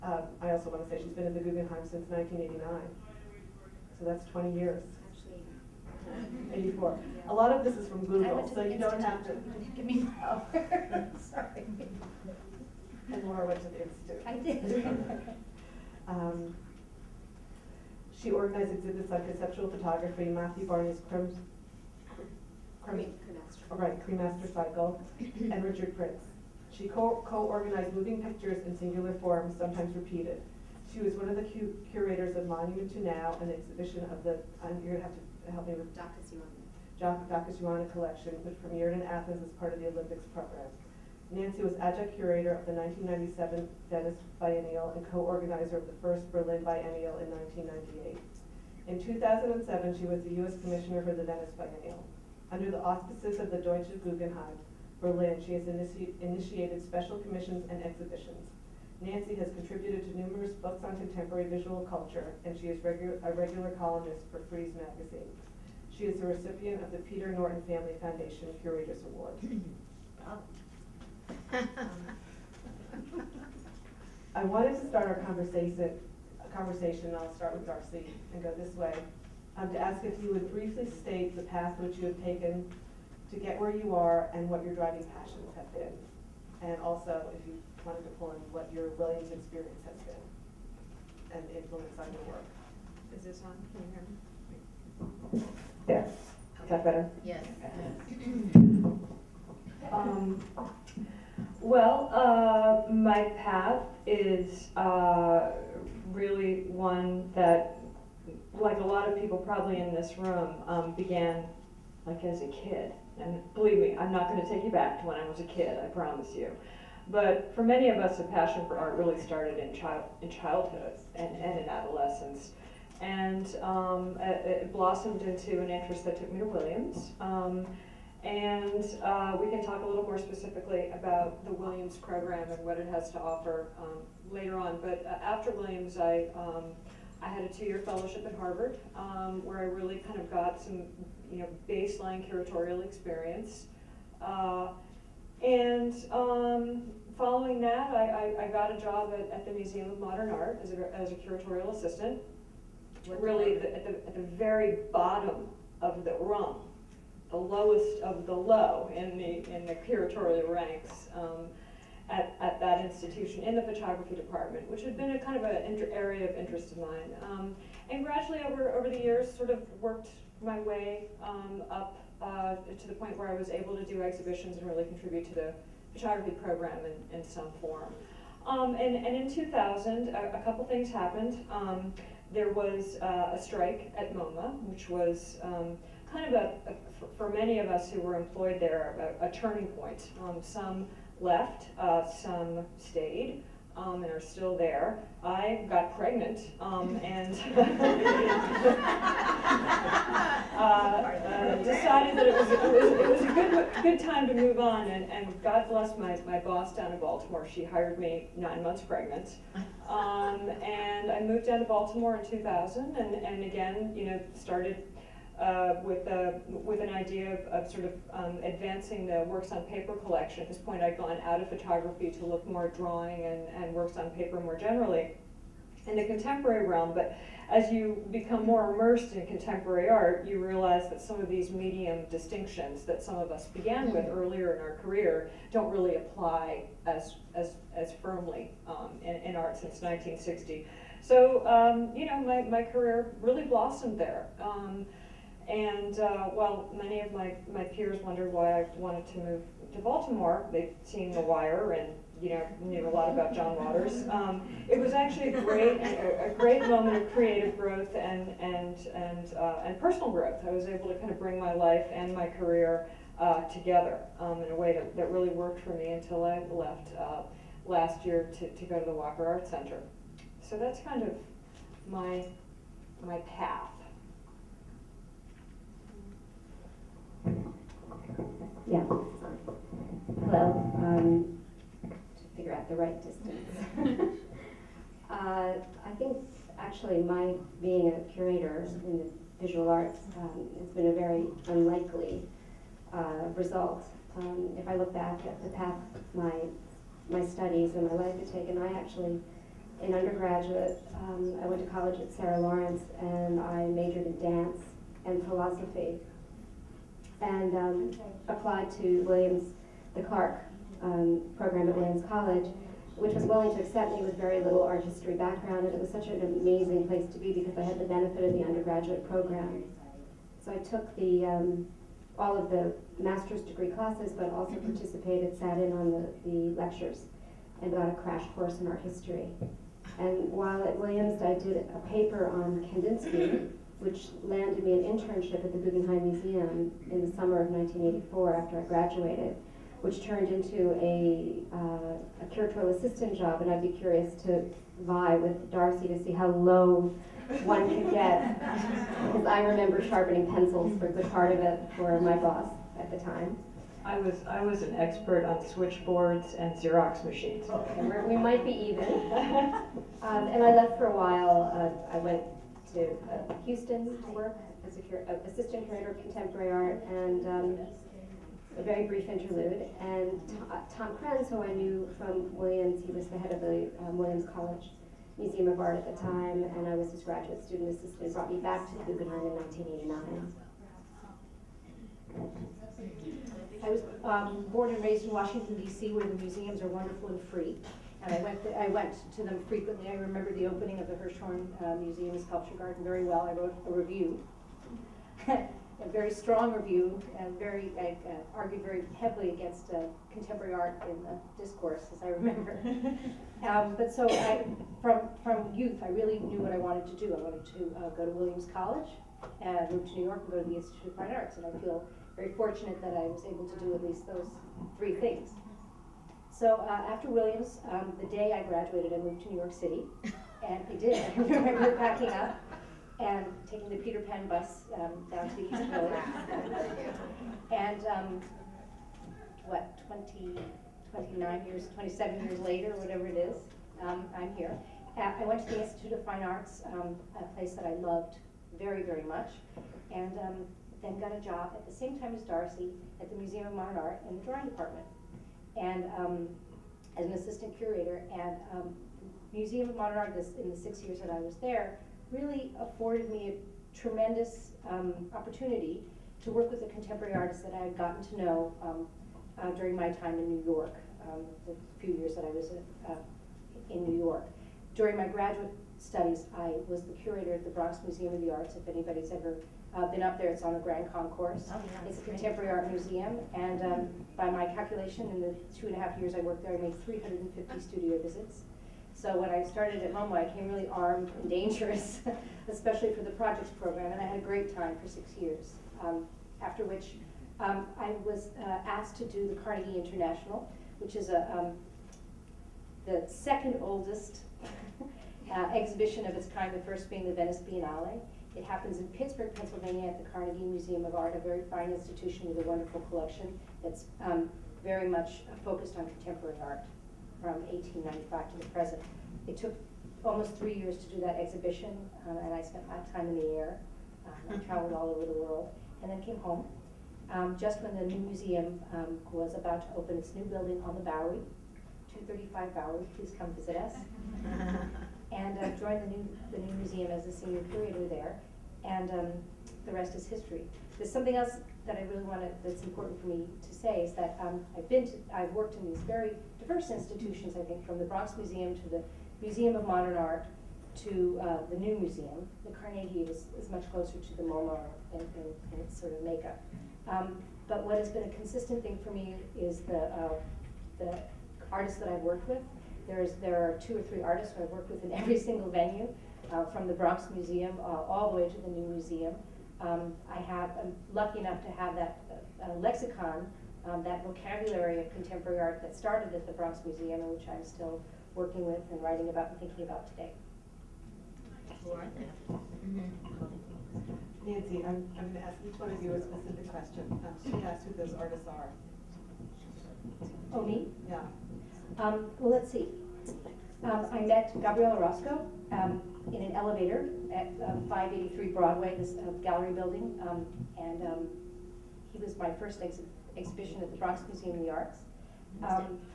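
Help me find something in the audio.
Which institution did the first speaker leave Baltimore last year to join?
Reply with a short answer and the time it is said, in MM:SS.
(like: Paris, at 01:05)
Walker Art Center, at 04:28.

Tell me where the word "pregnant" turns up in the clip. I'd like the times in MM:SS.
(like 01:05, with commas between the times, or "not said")
03:15, 03:28.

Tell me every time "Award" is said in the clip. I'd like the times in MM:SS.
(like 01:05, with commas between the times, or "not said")
01:09.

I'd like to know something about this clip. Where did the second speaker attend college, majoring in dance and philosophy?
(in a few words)
Sarah Lawrence.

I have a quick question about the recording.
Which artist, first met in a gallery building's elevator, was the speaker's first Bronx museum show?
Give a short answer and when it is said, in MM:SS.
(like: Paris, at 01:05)
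Gabriel Orozco, at 09:44.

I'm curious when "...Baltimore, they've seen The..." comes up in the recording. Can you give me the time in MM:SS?
04:09.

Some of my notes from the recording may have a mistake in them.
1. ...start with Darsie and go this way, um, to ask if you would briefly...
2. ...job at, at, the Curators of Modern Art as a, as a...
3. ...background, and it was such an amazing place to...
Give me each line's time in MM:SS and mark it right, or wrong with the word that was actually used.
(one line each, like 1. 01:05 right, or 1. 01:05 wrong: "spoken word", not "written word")
1. 01:17 right
2. 02:28 wrong: "Museum", not "Curators"
3. 05:15 right.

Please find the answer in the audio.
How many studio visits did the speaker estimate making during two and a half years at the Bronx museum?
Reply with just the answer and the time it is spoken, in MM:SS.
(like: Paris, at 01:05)
350, at 07:56.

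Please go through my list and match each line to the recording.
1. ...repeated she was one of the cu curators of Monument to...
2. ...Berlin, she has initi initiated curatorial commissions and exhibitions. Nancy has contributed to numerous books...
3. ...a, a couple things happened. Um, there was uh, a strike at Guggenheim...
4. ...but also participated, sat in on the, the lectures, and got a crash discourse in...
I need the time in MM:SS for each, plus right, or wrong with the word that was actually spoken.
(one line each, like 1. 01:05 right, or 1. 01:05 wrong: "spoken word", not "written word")
1. 00:29 right
2. 00:55 wrong: "special", not "curatorial"
3. 03:00 wrong: "MoMA", not "Guggenheim"
4. 05:24 wrong: "course", not "discourse".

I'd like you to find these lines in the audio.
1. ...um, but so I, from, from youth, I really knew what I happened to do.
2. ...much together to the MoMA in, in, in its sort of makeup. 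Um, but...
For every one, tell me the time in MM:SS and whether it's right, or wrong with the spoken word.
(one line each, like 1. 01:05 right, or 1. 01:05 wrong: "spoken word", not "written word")
1. 06:43 wrong: "wanted", not "happened"
2. 09:03 wrong: "closer", not "together".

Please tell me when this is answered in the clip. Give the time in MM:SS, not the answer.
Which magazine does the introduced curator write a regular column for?
01:04.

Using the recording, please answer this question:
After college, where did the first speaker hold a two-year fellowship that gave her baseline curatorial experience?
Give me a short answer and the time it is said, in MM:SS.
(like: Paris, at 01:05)
Harvard, at 02:18.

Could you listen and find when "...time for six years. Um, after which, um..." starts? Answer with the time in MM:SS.
08:04.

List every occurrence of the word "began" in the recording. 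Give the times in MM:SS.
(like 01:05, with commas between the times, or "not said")
01:50, 03:53.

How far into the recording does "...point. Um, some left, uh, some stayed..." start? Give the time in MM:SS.
03:09.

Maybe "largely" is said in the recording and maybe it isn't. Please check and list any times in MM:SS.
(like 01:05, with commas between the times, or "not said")
not said.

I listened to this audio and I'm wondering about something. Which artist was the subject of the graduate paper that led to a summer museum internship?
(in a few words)
Kandinsky.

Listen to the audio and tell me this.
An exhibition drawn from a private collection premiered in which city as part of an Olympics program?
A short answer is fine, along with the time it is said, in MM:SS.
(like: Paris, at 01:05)
Athens, at 00:39.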